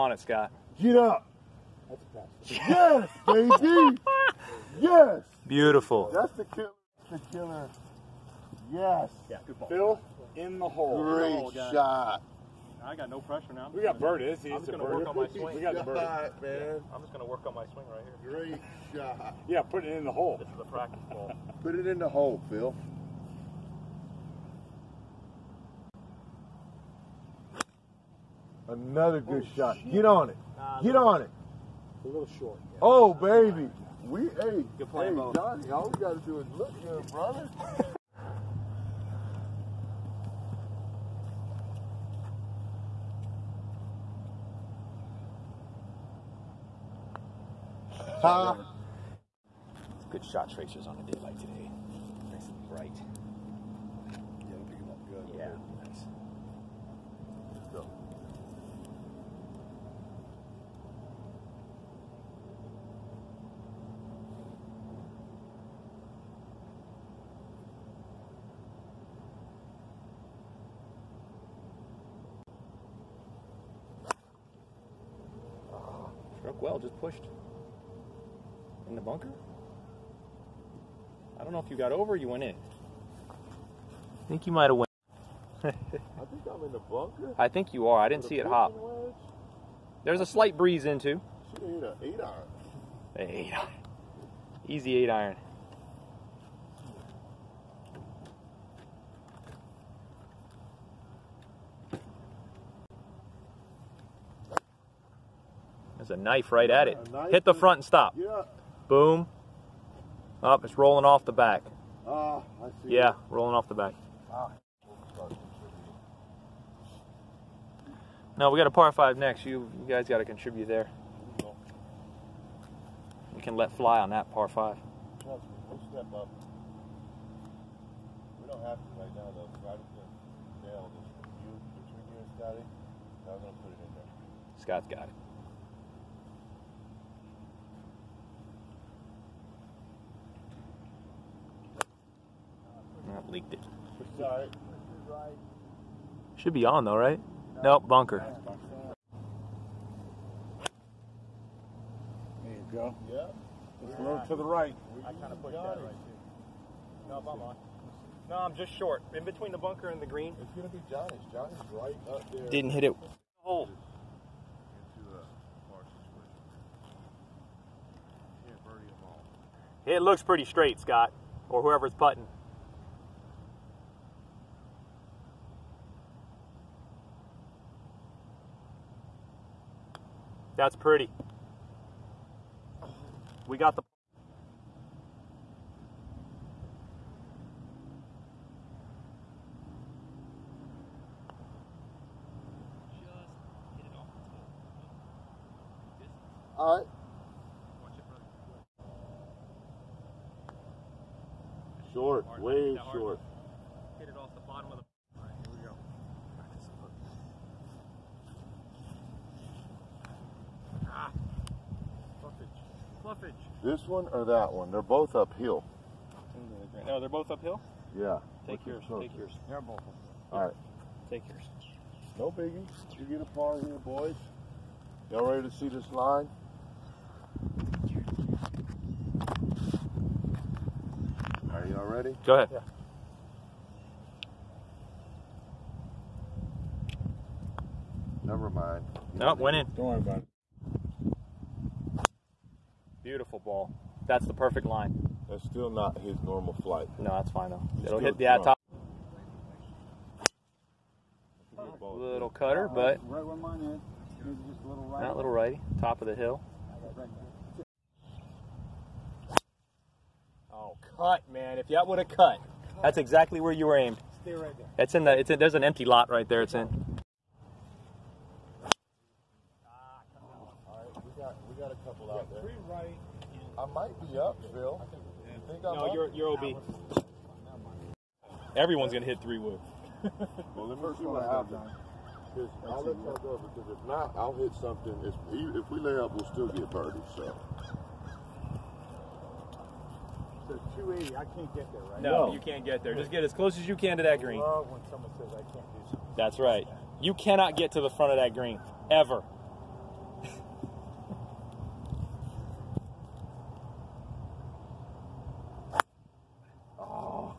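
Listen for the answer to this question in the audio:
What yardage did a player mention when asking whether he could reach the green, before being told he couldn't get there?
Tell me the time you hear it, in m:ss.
4:50.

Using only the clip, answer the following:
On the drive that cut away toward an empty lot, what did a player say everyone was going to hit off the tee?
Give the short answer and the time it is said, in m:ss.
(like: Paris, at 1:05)
three wood, at 4:39.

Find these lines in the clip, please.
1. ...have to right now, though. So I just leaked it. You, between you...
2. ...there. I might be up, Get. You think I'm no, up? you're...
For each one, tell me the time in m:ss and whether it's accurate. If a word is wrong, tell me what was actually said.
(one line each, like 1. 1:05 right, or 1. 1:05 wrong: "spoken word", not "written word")
1. 2:08 wrong: "nailed", not "leaked"
2. 4:32 wrong: "Phil", not "Get".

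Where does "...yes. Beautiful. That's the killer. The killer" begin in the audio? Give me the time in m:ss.
0:04.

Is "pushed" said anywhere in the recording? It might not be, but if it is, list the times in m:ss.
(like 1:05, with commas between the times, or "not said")
1:16, 2:35.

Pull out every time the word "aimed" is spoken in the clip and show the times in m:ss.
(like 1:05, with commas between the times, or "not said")
4:23.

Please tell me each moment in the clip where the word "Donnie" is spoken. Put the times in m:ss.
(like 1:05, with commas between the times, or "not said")
0:35.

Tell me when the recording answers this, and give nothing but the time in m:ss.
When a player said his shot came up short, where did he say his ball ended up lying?
2:39.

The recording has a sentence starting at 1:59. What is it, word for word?
You, you guys got to contribute there.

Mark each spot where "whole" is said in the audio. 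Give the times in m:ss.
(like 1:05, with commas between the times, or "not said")
not said.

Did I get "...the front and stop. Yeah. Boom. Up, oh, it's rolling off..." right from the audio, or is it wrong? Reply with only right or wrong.
right.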